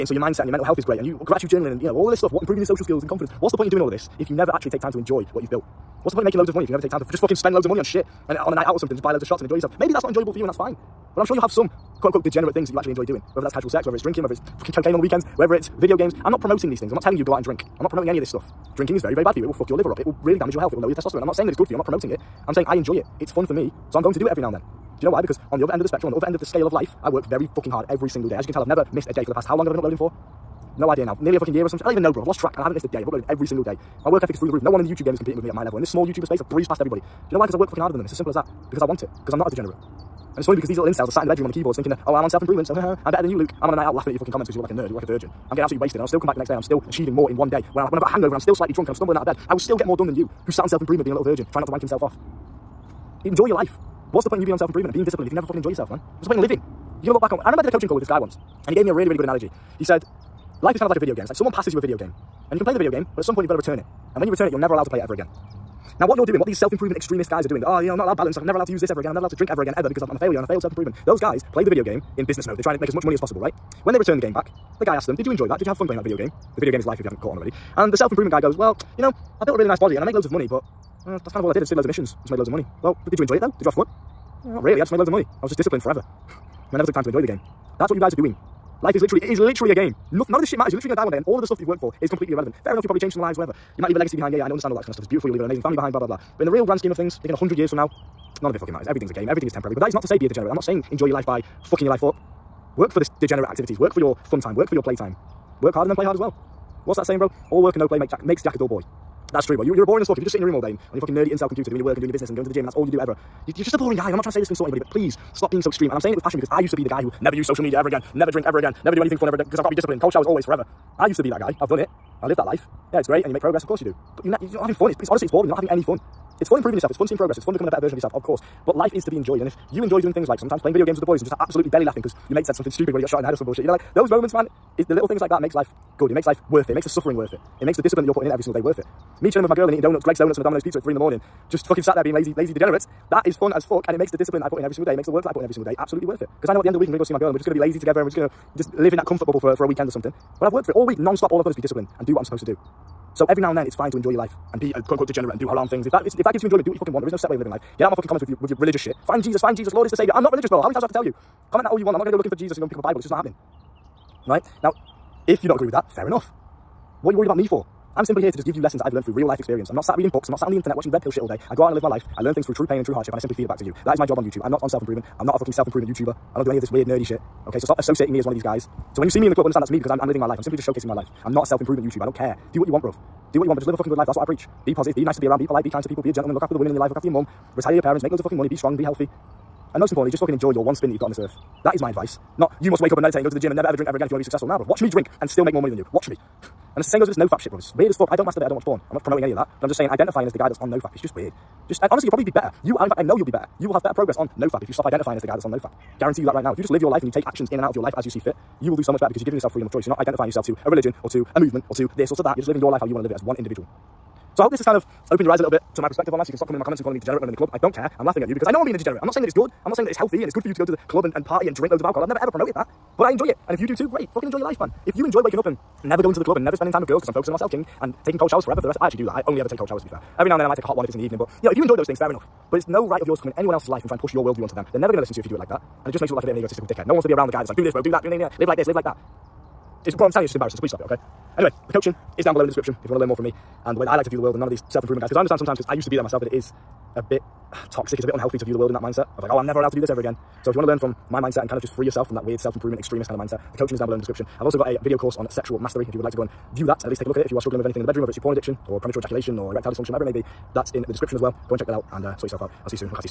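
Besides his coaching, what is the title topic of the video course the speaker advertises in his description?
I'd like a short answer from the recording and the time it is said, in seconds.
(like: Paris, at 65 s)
sexual mastery, at 255 s.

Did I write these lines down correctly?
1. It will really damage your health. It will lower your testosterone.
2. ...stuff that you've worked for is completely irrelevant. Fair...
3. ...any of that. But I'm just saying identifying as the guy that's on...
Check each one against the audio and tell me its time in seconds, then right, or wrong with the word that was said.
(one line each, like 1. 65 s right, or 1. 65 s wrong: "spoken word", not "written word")
1. 19 s right
2. 91 s right
3. 199 s right.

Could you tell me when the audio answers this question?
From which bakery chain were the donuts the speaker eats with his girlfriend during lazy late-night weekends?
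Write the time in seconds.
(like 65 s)
140 s.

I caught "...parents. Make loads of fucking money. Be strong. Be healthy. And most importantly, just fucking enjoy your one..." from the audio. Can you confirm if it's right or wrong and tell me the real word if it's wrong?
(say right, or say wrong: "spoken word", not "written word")
right.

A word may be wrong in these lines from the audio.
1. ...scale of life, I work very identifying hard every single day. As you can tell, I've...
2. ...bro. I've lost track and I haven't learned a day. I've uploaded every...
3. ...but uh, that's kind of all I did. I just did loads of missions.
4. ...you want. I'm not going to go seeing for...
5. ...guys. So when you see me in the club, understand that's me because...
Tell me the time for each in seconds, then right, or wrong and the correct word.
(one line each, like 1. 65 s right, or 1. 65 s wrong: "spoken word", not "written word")
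1. 26 s wrong: "fucking", not "identifying"
2. 32 s wrong: "missed", not "learned"
3. 80 s right
4. 161 s wrong: "looking", not "seeing"
5. 178 s right.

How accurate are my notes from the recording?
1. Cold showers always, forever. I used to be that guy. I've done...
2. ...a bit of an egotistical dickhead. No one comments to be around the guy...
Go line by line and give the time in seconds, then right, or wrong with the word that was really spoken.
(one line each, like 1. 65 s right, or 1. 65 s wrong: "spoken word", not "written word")
1. 120 s right
2. 236 s wrong: "wants", not "comments".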